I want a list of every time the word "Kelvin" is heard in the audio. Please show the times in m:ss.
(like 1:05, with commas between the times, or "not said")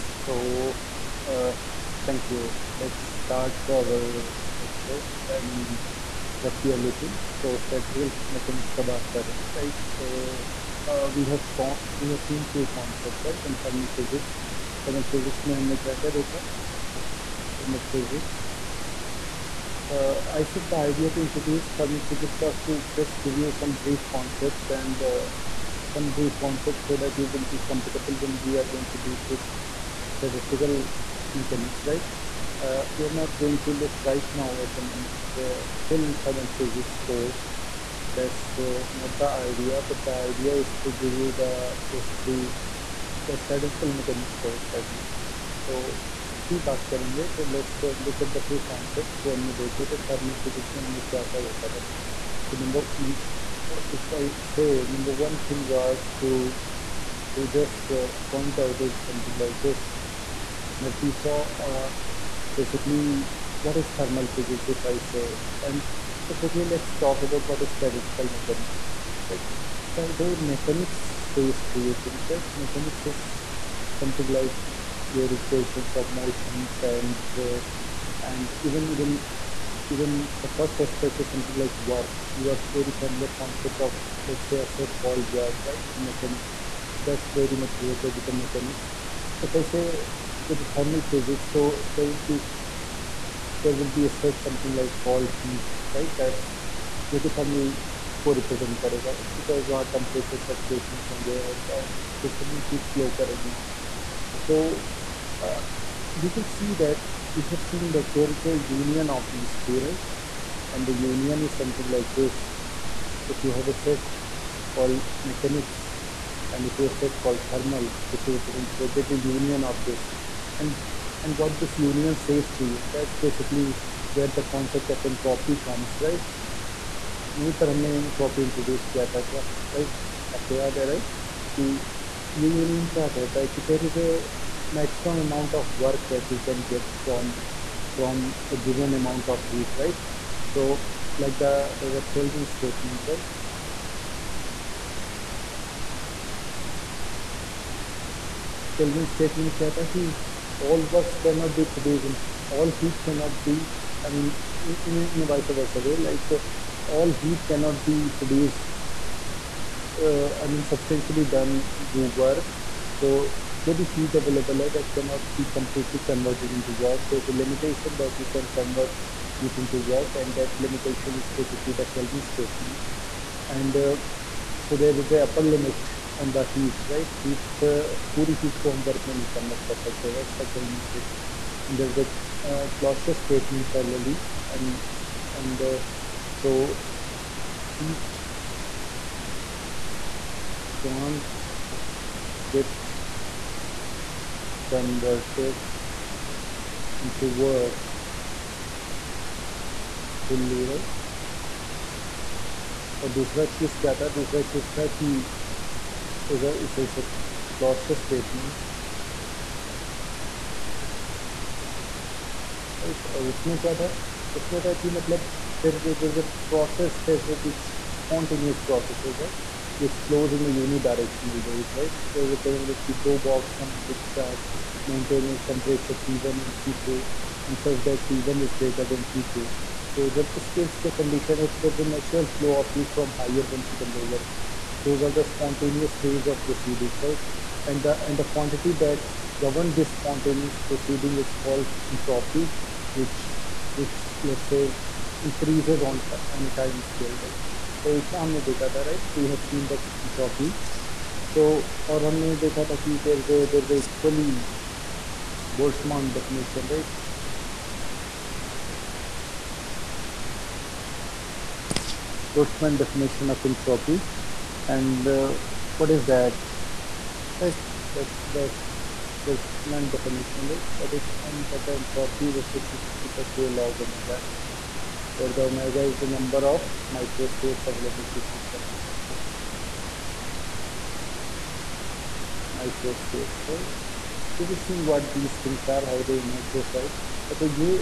2:22, 2:28, 2:51, 3:00.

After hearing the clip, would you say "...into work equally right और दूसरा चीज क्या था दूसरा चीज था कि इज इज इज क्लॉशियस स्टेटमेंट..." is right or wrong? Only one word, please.
wrong.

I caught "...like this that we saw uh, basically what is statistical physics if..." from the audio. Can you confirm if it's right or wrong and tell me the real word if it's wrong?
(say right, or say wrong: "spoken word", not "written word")
wrong: "thermal", not "statistical".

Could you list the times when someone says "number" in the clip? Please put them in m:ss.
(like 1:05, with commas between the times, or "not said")
0:54, 4:36.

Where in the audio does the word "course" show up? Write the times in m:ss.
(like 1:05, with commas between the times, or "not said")
0:37, 0:44.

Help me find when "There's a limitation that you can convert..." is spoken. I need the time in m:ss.
2:47.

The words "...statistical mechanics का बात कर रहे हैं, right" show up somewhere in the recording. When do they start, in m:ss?
0:07.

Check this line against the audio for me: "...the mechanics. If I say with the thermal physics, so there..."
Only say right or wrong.
right.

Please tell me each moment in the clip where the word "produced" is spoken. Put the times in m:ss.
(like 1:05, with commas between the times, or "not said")
2:31, 2:38.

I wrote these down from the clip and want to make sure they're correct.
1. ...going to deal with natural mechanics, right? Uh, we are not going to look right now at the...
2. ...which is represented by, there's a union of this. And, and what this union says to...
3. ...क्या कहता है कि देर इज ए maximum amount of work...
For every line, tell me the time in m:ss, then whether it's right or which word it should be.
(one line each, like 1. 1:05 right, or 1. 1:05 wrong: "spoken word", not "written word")
1. 0:28 wrong: "statistical", not "natural"
2. 1:58 right
3. 2:12 right.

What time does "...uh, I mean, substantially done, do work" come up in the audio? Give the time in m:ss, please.
2:40.